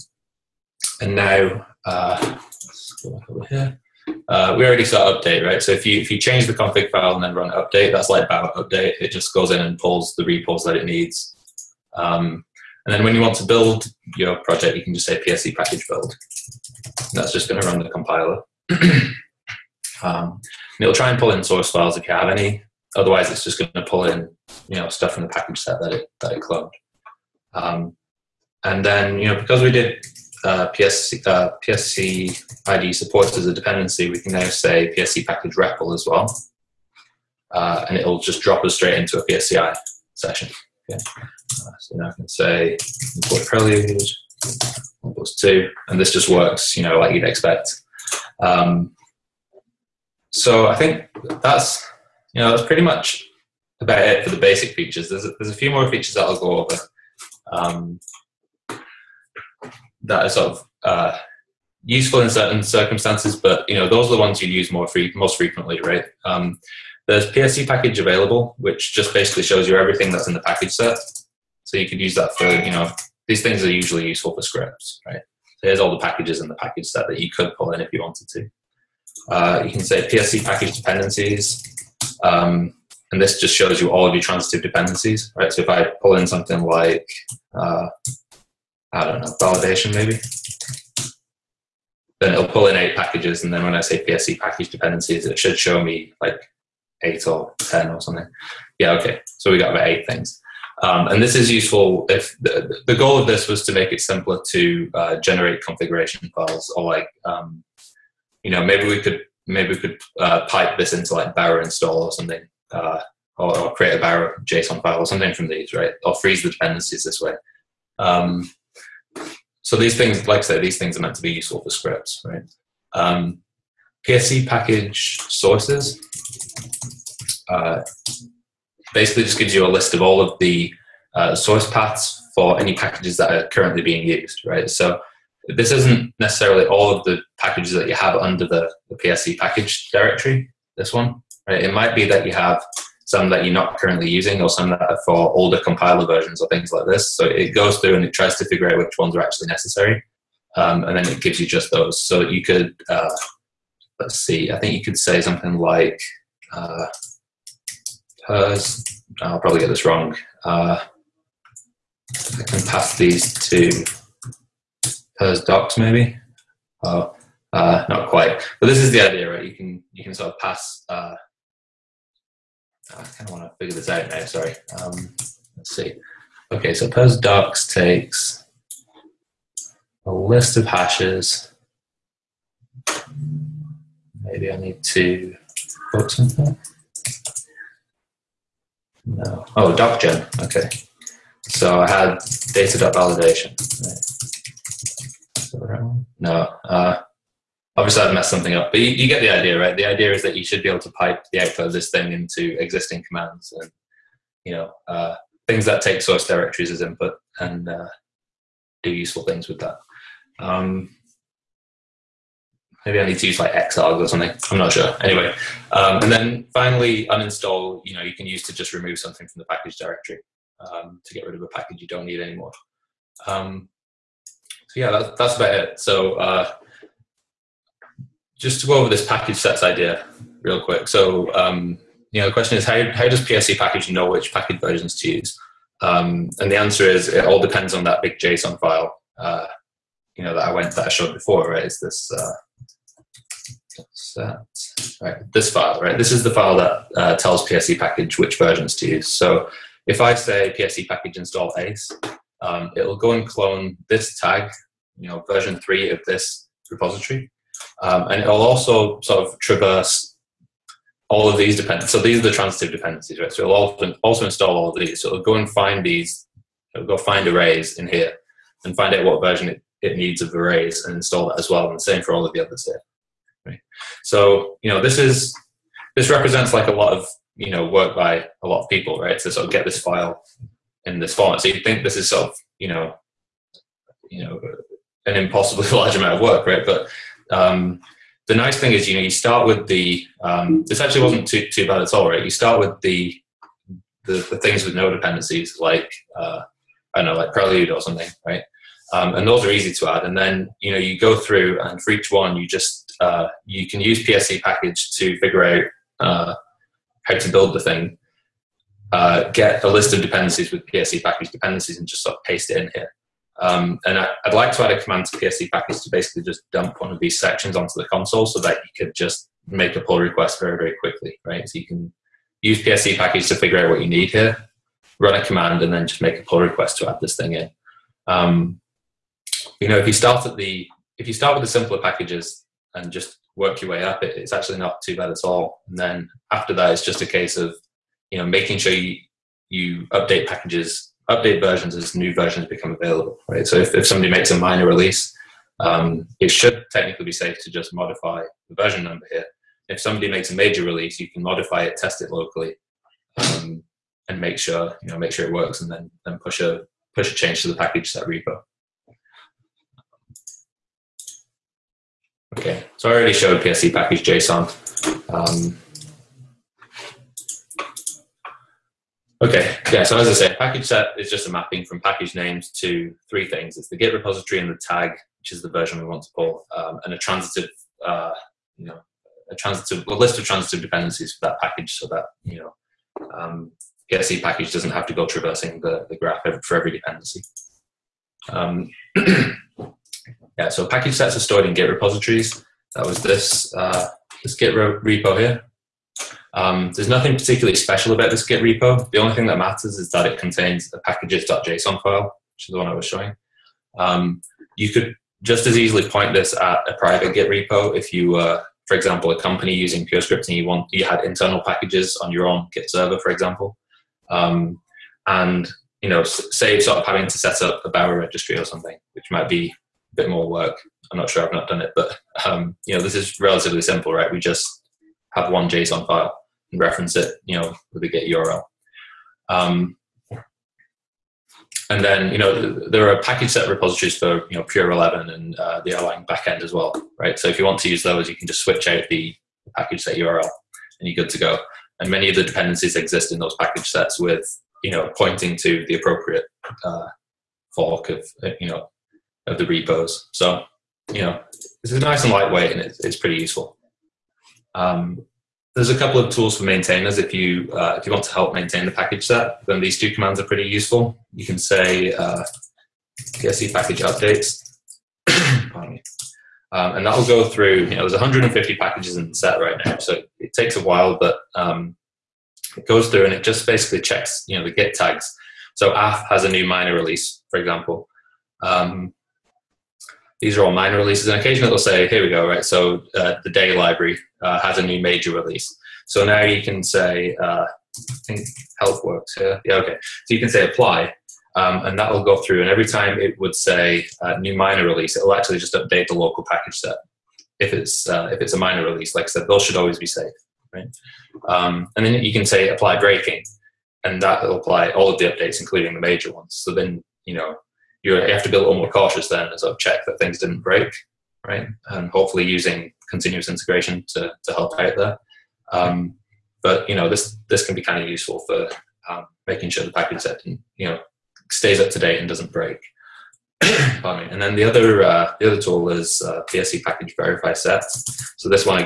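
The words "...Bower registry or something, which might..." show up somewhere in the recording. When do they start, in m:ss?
6:57.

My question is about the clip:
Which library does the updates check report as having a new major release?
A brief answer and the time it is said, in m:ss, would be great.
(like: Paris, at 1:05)
day, at 8:03.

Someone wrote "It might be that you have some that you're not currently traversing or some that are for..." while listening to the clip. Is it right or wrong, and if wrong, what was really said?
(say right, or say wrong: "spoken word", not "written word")
wrong: "using", not "traversing".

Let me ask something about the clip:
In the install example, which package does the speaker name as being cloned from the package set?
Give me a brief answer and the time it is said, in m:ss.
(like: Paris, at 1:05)
ace, at 4:11.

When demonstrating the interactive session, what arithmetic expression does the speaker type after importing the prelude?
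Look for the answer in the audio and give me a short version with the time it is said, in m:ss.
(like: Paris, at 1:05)
1 + 2, at 0:44.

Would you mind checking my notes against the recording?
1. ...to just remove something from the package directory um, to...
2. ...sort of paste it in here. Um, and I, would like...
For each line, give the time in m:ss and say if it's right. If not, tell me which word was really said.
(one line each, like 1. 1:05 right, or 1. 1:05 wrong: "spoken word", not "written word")
1. 3:38 right
2. 5:12 right.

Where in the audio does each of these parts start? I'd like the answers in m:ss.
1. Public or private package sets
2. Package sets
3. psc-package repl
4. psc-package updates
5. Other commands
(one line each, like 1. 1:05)
1. 6:23
2. 3:53
3. 0:27
4. 7:33
5. 1:03.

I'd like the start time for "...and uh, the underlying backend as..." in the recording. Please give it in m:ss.
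7:15.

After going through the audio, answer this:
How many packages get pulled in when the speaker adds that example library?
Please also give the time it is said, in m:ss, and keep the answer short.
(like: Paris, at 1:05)
8, at 1:32.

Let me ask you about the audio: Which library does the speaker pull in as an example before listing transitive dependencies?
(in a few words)
validation.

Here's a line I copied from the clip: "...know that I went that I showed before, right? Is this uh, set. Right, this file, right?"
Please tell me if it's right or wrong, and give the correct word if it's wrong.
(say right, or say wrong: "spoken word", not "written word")
right.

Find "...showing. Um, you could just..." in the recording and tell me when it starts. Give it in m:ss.
6:42.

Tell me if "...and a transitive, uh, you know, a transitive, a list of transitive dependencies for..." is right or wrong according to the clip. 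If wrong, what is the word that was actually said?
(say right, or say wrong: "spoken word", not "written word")
right.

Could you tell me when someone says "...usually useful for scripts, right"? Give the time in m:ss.
1:13.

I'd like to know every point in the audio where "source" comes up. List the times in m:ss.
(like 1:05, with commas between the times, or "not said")
0:21, 2:05, 2:11, 3:26.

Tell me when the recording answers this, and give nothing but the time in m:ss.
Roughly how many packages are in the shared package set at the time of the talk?
7:47.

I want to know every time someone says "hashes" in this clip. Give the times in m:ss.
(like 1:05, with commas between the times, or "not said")
3:00.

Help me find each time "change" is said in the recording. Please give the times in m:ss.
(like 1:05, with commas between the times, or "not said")
0:06, 5:57.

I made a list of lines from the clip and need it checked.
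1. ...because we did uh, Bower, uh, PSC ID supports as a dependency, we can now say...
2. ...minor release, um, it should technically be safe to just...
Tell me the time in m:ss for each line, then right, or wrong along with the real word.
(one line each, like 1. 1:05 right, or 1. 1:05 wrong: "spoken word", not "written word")
1. 0:29 wrong: "PSC", not "Bower"
2. 5:44 right.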